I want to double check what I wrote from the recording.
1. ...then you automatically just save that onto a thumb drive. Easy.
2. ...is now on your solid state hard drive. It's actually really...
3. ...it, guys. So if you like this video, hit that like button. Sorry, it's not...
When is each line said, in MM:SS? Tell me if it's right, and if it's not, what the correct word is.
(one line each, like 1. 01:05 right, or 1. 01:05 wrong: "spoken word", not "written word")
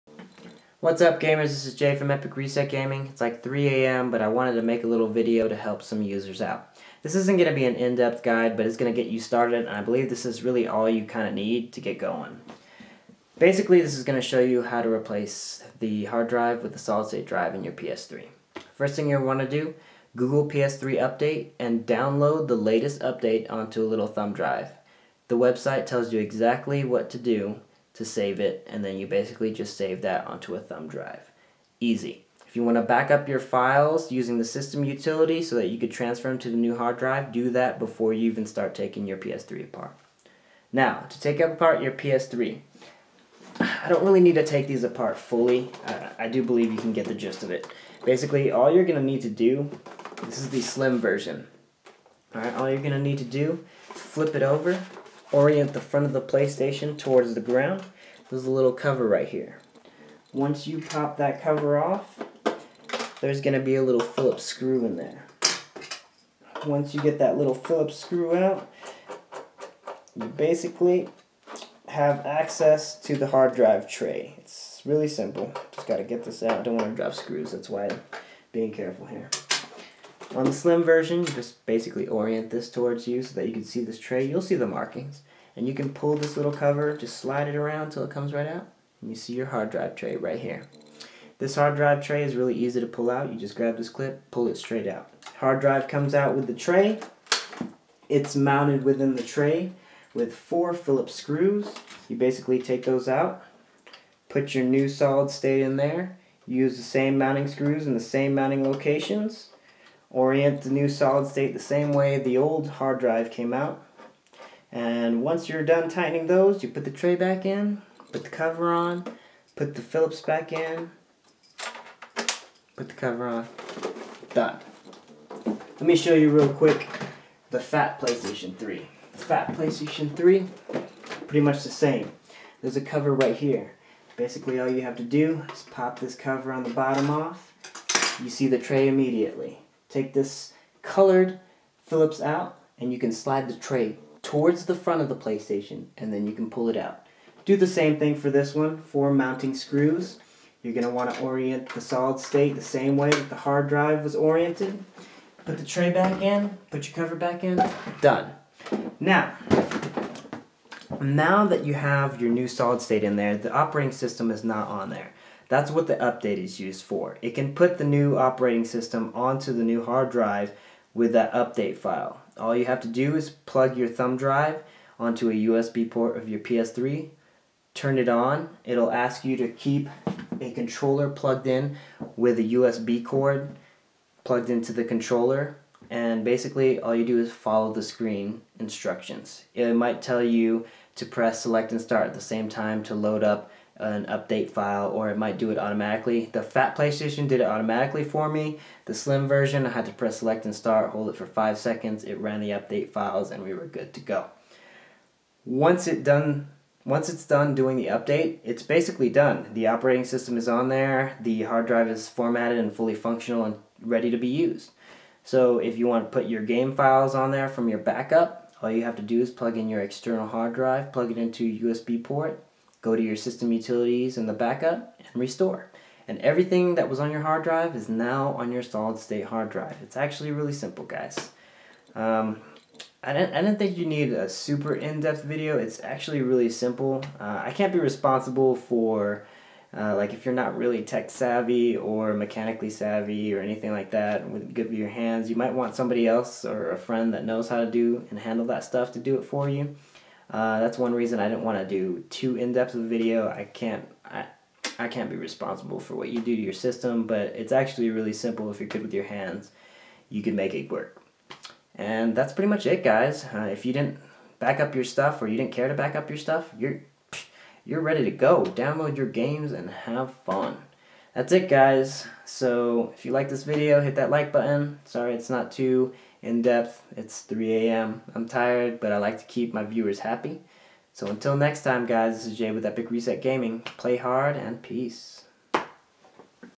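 1. 00:28 wrong: "basically", not "automatically"
2. 03:47 right
3. 04:31 right.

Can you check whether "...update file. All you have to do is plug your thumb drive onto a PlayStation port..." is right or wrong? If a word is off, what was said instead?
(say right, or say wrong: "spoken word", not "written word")
wrong: "USB", not "PlayStation".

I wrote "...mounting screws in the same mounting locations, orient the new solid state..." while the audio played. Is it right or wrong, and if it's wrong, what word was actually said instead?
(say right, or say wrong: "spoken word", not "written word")
right.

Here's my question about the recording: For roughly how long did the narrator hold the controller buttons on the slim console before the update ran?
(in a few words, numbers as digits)
5 seconds.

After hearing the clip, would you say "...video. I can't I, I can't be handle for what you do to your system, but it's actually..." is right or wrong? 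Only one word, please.
wrong.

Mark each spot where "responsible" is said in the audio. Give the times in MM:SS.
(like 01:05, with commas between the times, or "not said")
03:57, 04:15.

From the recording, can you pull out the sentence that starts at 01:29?
And you see your hard drive tray right here.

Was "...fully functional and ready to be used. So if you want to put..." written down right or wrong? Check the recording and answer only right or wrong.
right.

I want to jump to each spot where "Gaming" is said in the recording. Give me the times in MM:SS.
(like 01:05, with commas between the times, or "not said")
00:02, 04:43.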